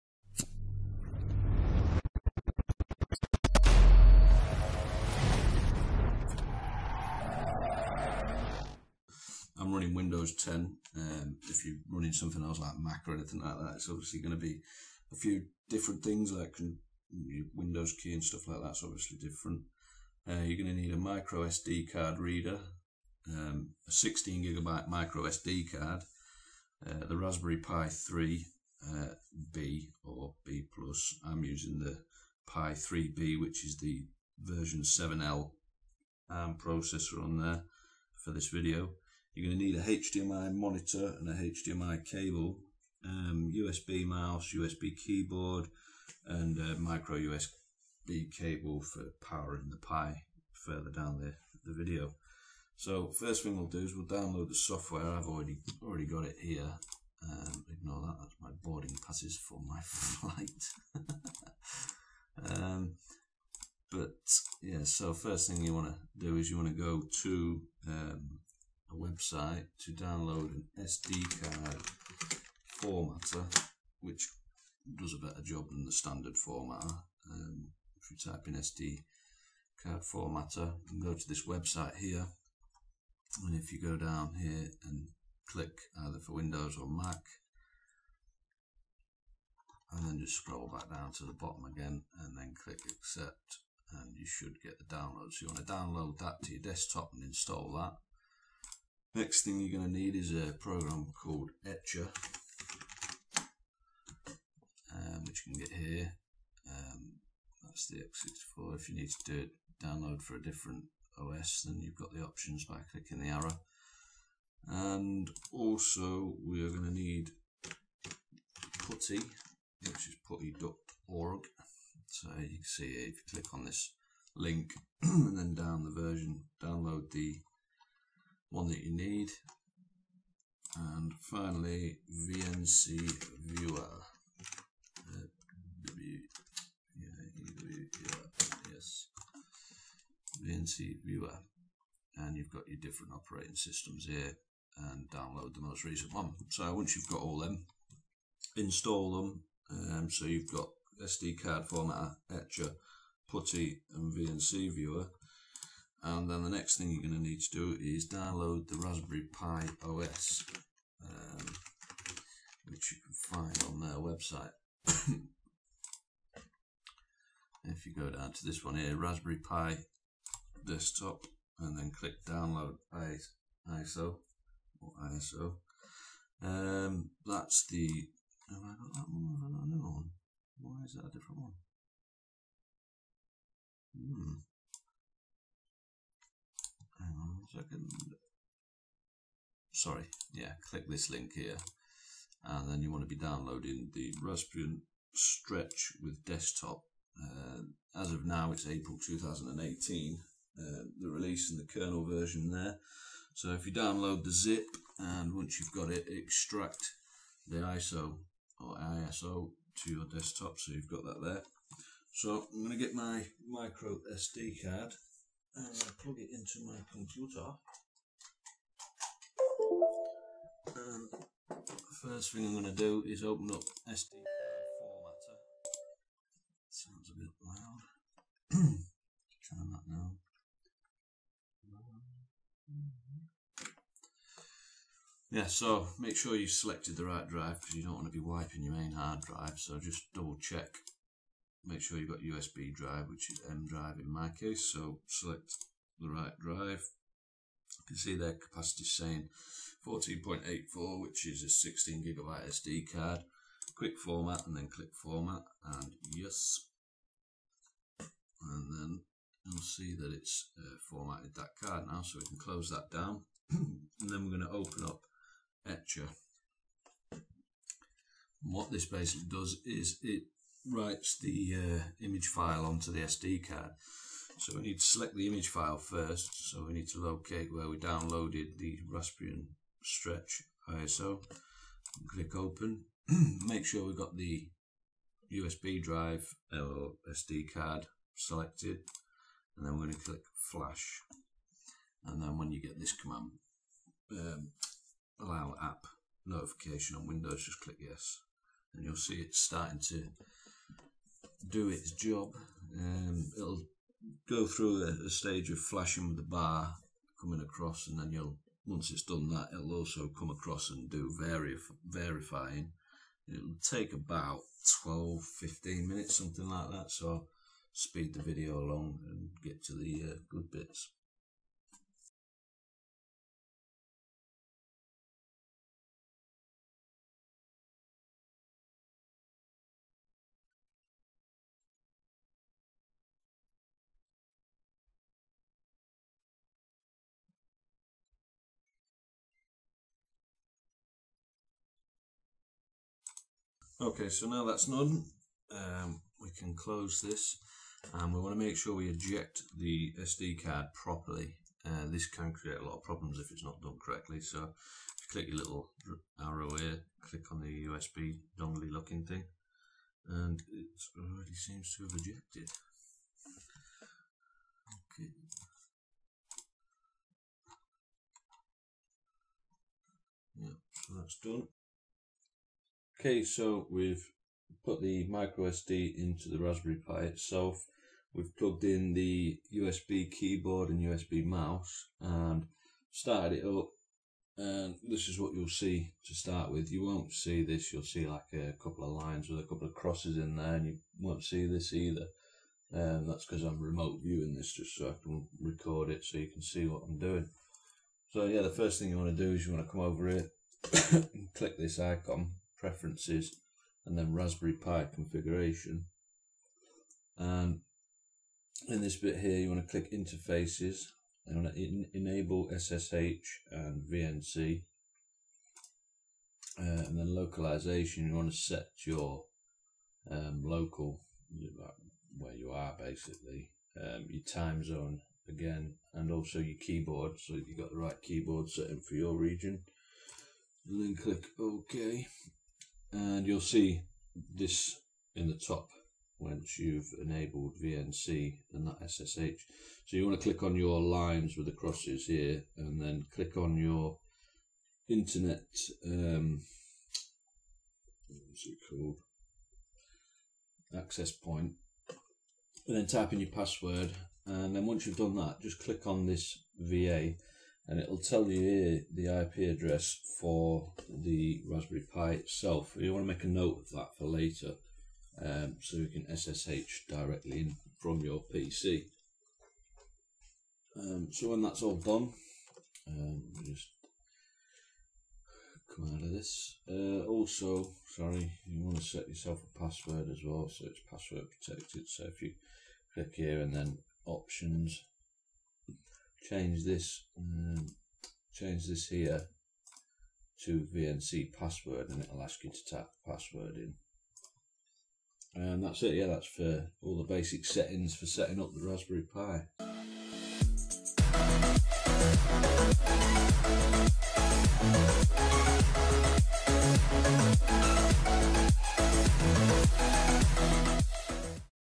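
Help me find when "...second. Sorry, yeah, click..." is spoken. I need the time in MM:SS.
03:07.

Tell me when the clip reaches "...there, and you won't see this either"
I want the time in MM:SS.
06:30.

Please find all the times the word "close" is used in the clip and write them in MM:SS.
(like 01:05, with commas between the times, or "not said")
04:22, 05:46.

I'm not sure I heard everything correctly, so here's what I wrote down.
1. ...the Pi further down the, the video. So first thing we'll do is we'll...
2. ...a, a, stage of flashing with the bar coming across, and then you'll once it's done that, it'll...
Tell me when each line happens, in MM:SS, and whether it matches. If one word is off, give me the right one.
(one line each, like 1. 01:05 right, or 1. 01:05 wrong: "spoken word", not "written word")
1. 00:49 right
2. 05:04 right.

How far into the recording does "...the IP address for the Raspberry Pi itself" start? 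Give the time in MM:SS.
07:38.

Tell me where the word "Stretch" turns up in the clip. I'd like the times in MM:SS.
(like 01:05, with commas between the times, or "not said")
03:15, 04:39.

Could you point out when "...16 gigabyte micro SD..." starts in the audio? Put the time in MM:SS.
00:23.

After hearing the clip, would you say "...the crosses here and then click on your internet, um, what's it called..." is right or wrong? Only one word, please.
right.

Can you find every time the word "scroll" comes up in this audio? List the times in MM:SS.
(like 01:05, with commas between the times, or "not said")
01:30.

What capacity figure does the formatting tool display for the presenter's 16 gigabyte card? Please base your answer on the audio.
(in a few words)
14.84.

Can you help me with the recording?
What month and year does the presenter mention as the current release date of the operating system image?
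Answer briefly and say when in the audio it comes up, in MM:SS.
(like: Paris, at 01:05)
April 2018, at 03:18.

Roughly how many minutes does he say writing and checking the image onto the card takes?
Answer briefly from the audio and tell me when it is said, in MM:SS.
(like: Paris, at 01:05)
12 to 15 minutes, at 05:14.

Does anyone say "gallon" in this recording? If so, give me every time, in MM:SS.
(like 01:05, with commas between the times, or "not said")
not said.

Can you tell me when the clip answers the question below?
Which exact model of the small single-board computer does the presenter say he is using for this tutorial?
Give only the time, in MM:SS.
00:32.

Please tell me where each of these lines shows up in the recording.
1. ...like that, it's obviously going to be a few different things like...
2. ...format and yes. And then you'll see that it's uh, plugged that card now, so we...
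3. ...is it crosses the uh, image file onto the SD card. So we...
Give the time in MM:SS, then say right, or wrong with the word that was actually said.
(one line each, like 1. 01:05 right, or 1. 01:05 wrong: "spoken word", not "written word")
1. 00:13 right
2. 04:14 wrong: "formatted", not "plugged"
3. 04:29 wrong: "writes", not "crosses".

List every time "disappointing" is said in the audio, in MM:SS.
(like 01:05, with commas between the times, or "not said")
not said.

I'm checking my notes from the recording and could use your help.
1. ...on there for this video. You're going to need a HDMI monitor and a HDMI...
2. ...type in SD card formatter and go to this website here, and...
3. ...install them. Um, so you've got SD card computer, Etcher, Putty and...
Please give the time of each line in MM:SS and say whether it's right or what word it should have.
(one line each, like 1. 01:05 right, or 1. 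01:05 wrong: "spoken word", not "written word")
1. 00:37 right
2. 01:18 right
3. 02:28 wrong: "formatter", not "computer".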